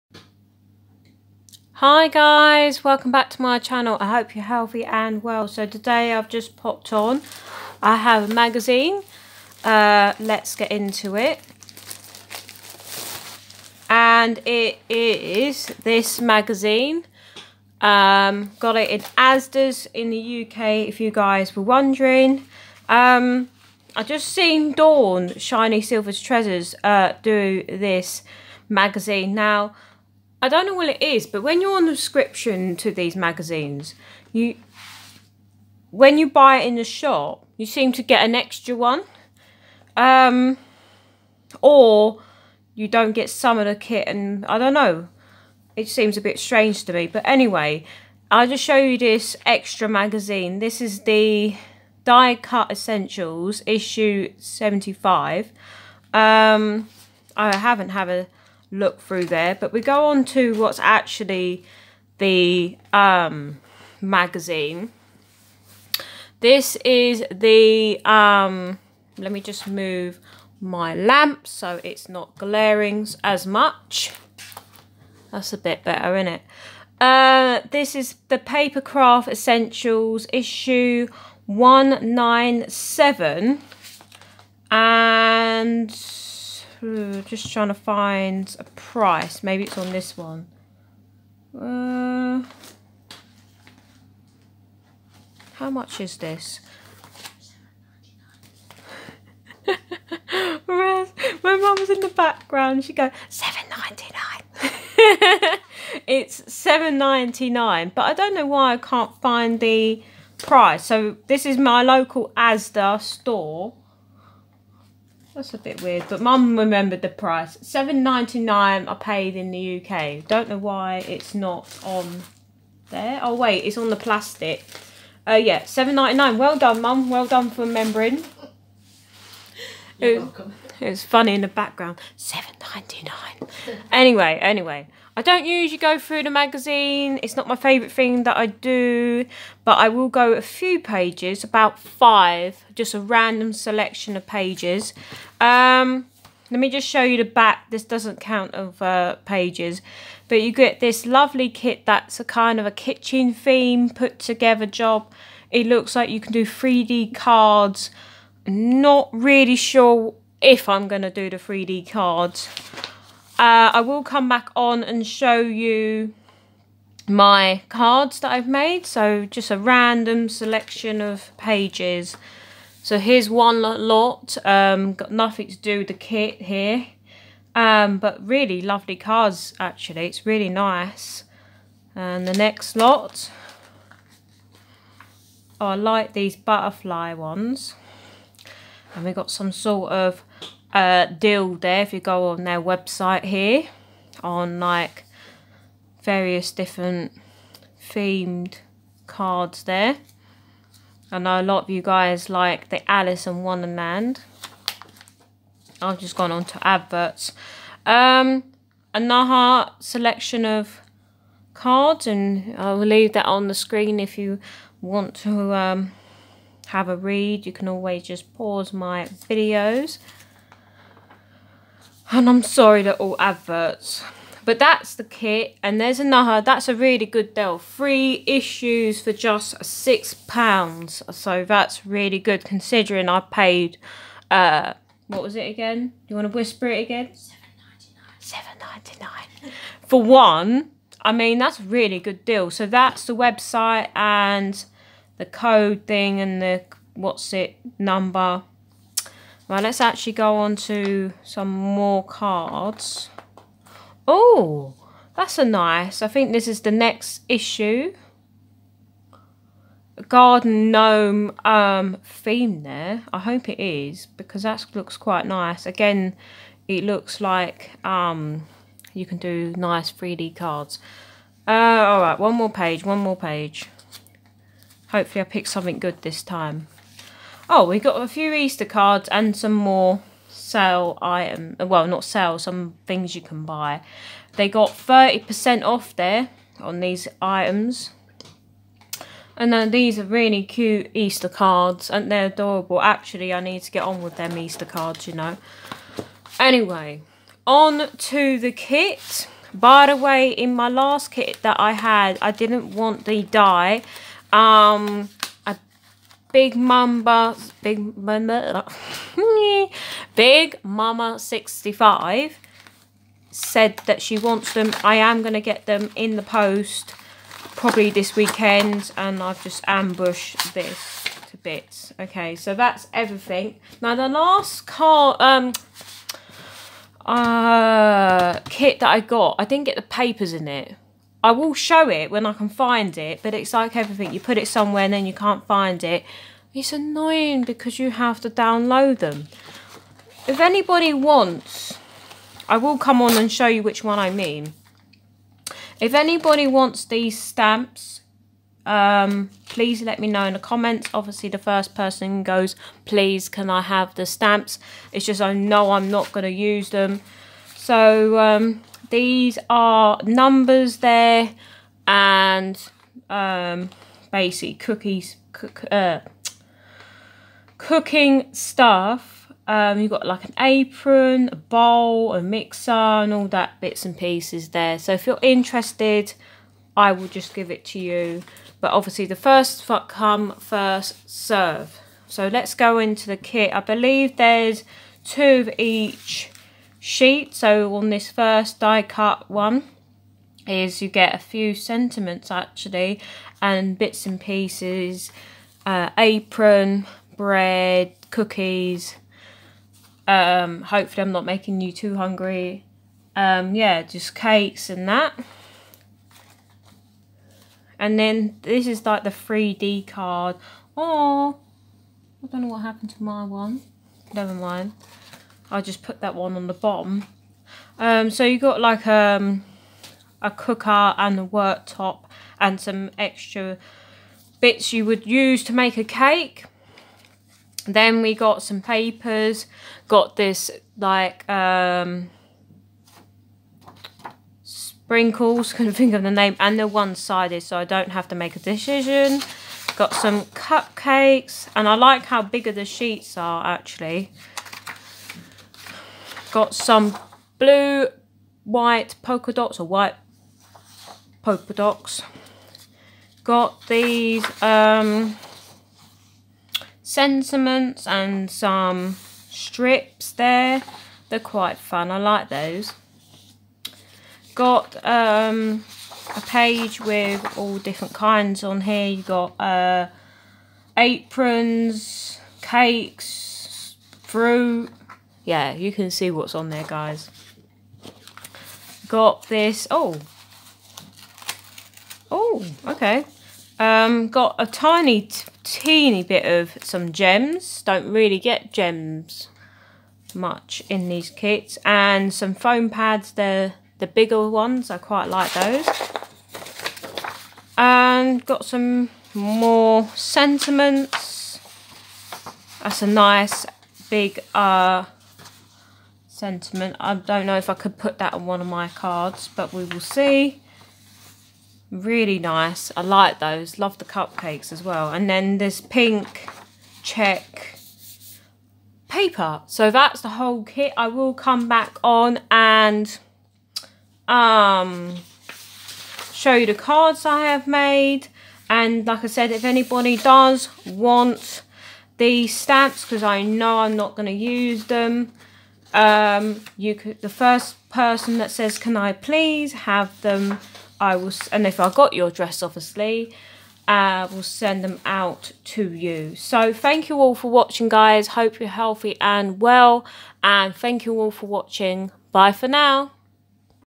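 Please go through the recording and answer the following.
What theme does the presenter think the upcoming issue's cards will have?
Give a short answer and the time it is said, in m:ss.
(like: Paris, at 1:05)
Garden gnome, at 4:20.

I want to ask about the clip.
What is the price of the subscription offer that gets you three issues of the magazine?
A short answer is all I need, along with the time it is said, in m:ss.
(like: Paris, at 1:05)
£6, at 3:49.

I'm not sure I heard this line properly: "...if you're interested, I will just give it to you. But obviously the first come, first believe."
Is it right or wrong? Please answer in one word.
wrong.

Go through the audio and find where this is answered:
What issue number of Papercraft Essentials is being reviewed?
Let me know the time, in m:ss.
1:20.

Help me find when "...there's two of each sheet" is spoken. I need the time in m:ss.
6:24.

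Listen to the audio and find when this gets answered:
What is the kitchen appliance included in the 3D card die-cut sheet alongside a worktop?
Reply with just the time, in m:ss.
7:00.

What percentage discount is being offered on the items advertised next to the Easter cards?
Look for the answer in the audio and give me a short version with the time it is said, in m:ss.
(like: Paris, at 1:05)
30%, at 4:44.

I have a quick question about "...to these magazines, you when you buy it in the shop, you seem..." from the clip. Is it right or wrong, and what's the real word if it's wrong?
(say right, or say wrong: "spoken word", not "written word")
right.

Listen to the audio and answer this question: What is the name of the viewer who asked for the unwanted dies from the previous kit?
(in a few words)
Big Mama 65.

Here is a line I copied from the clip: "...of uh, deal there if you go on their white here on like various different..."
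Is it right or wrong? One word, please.
wrong.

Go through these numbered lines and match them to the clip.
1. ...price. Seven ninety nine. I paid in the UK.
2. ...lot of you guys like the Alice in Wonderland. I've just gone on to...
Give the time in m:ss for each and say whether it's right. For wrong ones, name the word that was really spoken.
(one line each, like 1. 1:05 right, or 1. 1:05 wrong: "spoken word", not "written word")
1. 1:57 right
2. 3:21 right.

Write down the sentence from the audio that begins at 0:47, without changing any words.
But anyway, I'll just show you this extra magazine.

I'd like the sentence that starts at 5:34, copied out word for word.
You put it somewhere and then you can't find it.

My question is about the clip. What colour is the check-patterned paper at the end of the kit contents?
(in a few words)
Pink.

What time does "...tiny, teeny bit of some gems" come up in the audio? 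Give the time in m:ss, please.
8:04.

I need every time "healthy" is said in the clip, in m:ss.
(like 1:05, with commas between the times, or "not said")
0:04, 9:08.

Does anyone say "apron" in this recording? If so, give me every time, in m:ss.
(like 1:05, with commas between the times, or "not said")
6:10, 6:35, 7:50.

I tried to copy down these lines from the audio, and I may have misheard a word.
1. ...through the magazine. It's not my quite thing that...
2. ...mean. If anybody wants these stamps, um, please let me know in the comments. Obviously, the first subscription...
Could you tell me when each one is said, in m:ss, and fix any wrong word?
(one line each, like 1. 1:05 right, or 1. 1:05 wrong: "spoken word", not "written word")
1. 2:15 wrong: "favourite", not "quite"
2. 5:44 wrong: "person", not "subscription".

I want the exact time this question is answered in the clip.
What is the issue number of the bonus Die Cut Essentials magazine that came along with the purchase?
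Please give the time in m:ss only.
0:53.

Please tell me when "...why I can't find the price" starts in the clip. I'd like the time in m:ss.
1:48.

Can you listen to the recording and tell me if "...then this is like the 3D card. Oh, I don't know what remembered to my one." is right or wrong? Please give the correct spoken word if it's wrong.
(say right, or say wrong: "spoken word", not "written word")
wrong: "happened", not "remembered".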